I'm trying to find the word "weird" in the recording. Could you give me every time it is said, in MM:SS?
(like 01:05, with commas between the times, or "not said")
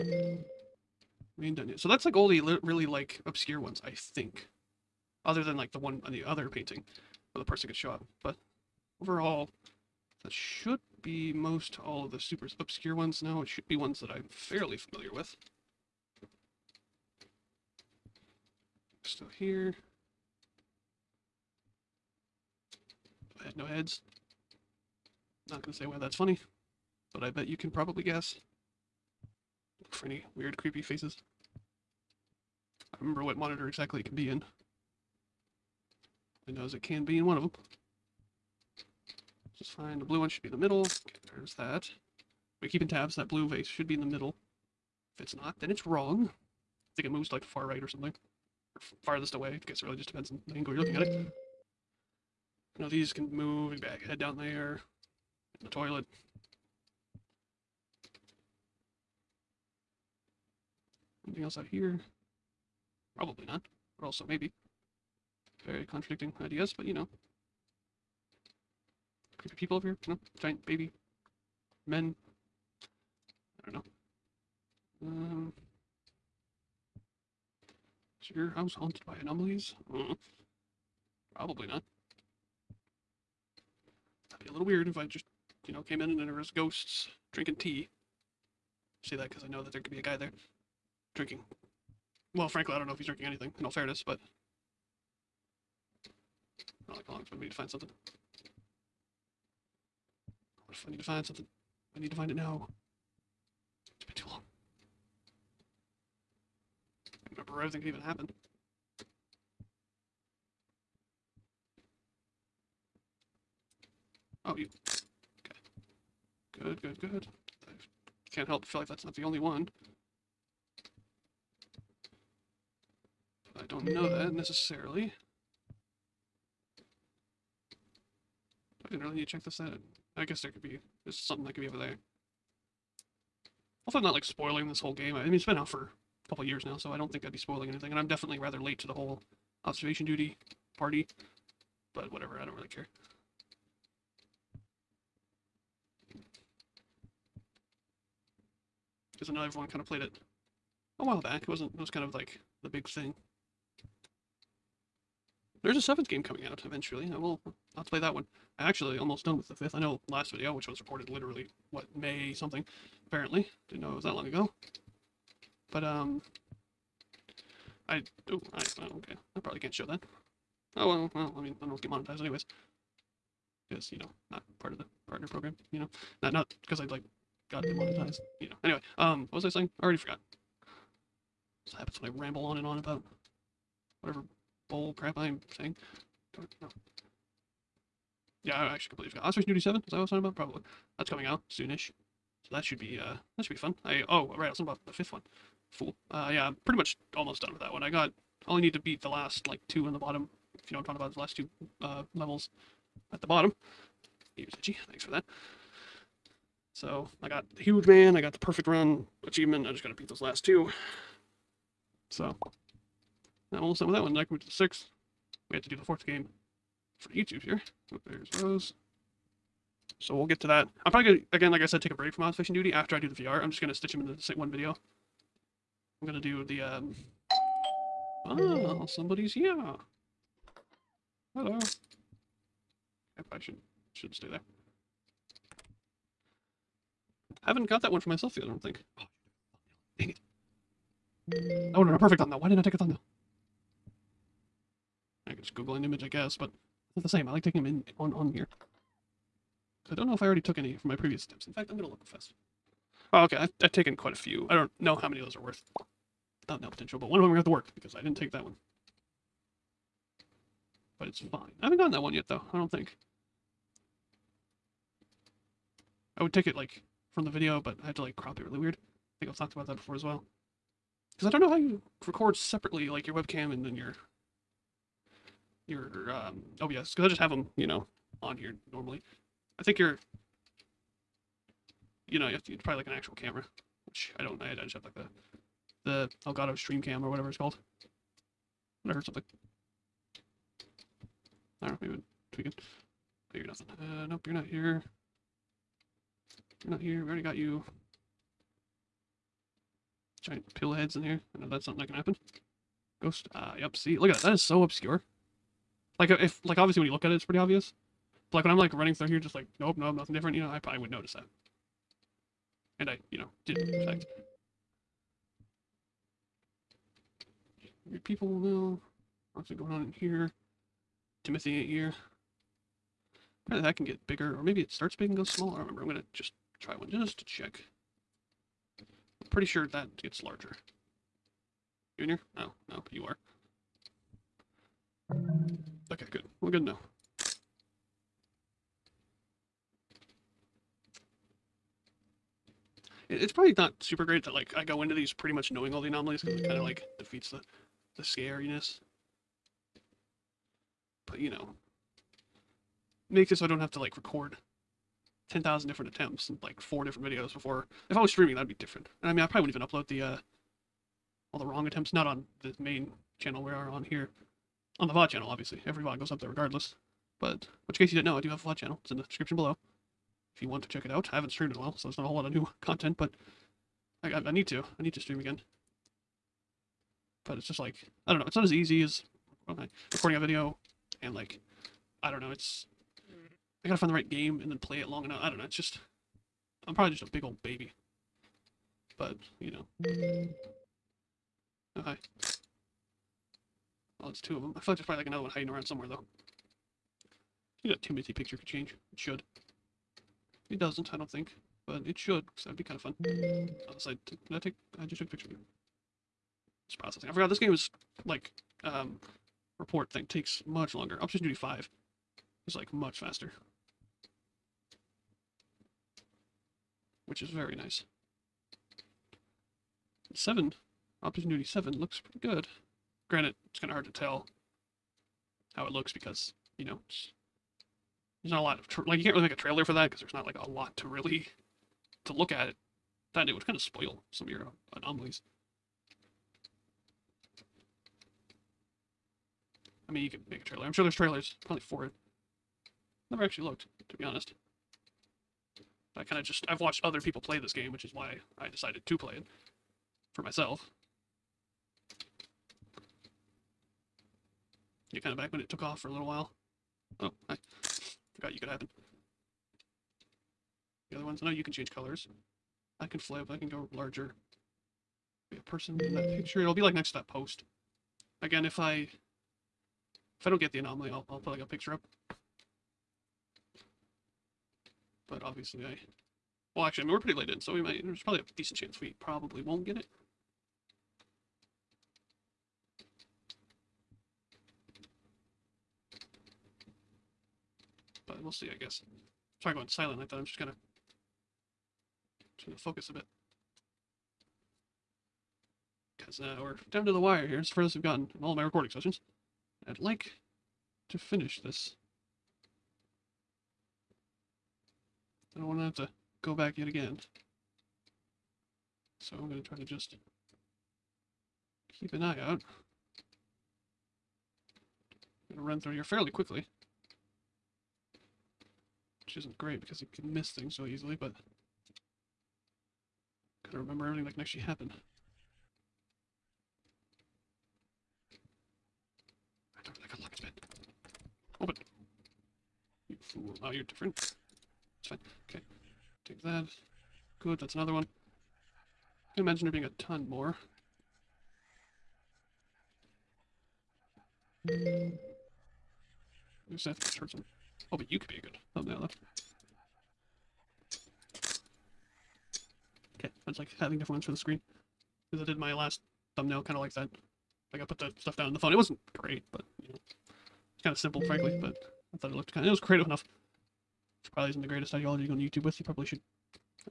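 00:30, 01:24, 04:28.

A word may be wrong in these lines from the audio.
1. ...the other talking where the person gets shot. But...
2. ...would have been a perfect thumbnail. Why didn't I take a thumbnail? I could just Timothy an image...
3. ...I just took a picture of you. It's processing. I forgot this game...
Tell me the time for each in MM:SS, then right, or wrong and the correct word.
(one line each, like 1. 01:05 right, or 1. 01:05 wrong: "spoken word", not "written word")
1. 00:06 wrong: "painting", not "talking"
2. 04:01 wrong: "Google", not "Timothy"
3. 06:44 right.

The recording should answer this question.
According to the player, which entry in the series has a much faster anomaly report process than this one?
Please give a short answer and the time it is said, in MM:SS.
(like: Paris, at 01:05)
Observation Duty 5, at 06:51.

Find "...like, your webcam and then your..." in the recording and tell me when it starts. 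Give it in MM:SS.
04:32.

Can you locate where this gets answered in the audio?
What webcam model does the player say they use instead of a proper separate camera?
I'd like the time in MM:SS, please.
04:46.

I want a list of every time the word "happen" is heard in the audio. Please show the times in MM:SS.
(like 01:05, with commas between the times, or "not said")
01:48, 03:01, 05:01, 07:38, 08:44.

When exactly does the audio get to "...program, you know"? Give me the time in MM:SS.
02:55.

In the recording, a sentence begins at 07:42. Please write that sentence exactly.
I can flip, I can go larger.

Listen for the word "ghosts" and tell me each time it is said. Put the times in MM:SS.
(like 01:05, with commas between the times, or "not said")
01:26, 05:03.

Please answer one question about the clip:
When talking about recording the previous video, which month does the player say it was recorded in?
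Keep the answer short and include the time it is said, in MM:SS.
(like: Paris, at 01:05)
May, at 02:41.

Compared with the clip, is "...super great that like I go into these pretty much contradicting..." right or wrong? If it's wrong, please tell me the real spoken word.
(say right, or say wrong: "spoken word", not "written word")
wrong: "knowing", not "contradicting".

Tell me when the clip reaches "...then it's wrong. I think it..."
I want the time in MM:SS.
00:45.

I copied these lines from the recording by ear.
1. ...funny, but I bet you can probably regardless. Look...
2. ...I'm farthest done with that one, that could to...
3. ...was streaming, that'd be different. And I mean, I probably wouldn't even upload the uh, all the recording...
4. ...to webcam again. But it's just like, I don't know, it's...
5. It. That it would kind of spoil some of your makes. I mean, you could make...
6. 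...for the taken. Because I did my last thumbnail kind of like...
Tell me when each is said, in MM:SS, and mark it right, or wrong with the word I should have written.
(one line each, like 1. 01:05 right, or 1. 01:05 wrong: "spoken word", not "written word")
1. 00:26 wrong: "guess", not "regardless"
2. 03:33 wrong: "almost", not "farthest"
3. 05:58 wrong: "wrong", not "recording"
4. 06:14 wrong: "stream", not "webcam"
5. 07:12 wrong: "anomalies", not "makes"
6. 09:14 wrong: "screen", not "taken".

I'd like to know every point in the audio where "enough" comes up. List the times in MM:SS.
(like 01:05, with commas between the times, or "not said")
06:25, 09:22.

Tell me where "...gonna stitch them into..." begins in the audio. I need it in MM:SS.
03:43.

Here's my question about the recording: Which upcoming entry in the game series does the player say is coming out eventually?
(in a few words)
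Seventh.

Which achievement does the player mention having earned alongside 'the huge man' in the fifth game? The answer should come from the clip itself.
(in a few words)
Perfect run.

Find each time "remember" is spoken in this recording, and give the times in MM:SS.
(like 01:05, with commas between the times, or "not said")
00:33, 01:47, 05:25, 08:43.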